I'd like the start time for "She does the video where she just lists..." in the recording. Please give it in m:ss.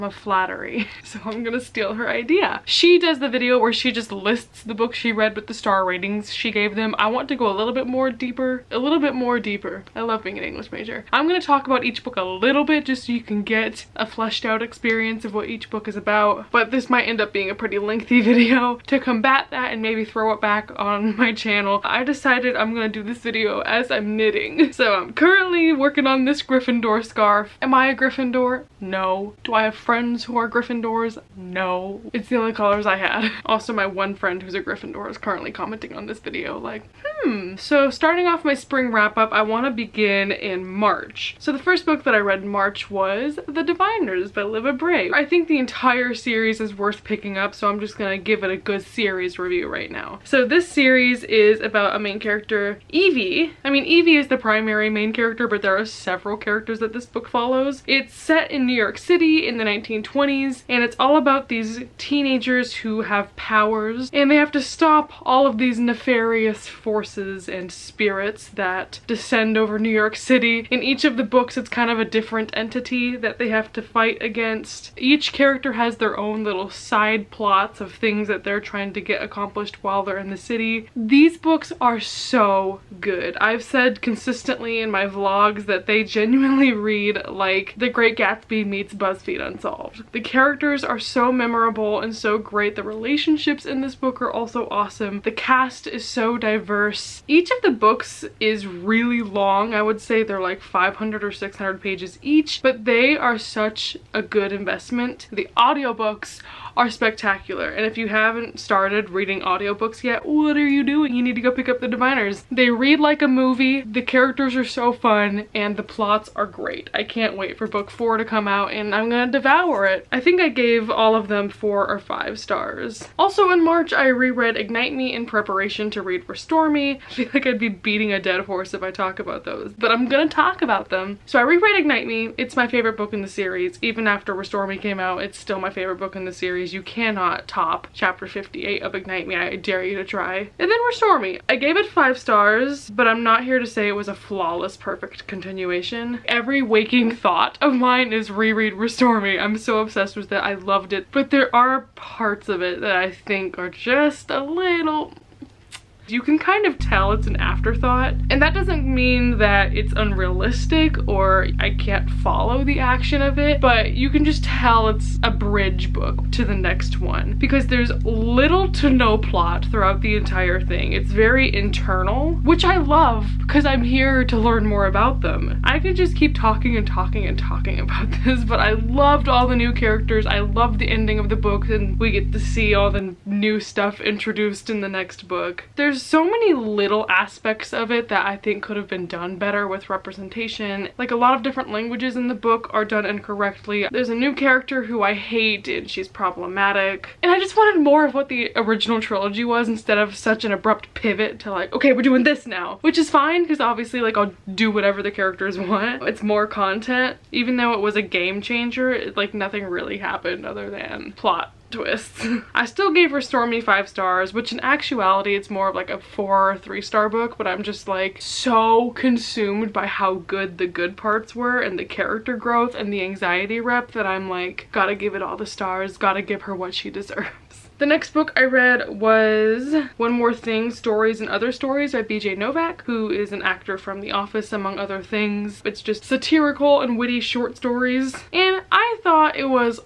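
0:02.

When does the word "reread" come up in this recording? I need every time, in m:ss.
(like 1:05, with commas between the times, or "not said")
2:04, 2:11, 2:28.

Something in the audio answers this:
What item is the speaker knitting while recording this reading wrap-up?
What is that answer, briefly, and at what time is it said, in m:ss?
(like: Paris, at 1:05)
Gryffindor scarf, at 0:26.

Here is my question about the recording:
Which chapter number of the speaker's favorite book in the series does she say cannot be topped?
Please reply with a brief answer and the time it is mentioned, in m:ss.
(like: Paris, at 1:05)
58, at 2:17.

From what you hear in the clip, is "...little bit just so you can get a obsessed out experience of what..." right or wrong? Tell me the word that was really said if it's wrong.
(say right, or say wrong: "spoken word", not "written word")
wrong: "fleshed", not "obsessed".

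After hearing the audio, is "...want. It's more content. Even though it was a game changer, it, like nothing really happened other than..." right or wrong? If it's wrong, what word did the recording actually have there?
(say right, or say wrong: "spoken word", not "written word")
right.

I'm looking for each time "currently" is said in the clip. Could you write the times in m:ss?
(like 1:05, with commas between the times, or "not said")
0:25, 0:35.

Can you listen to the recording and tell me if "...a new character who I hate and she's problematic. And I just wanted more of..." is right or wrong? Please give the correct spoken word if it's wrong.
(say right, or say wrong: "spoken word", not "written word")
right.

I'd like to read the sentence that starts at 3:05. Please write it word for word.
There's so many little aspects of it that I think could have been done better with representation.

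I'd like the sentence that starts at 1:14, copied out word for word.
Each character has their own little side plots of things that they're trying to get accomplished while they're in the city.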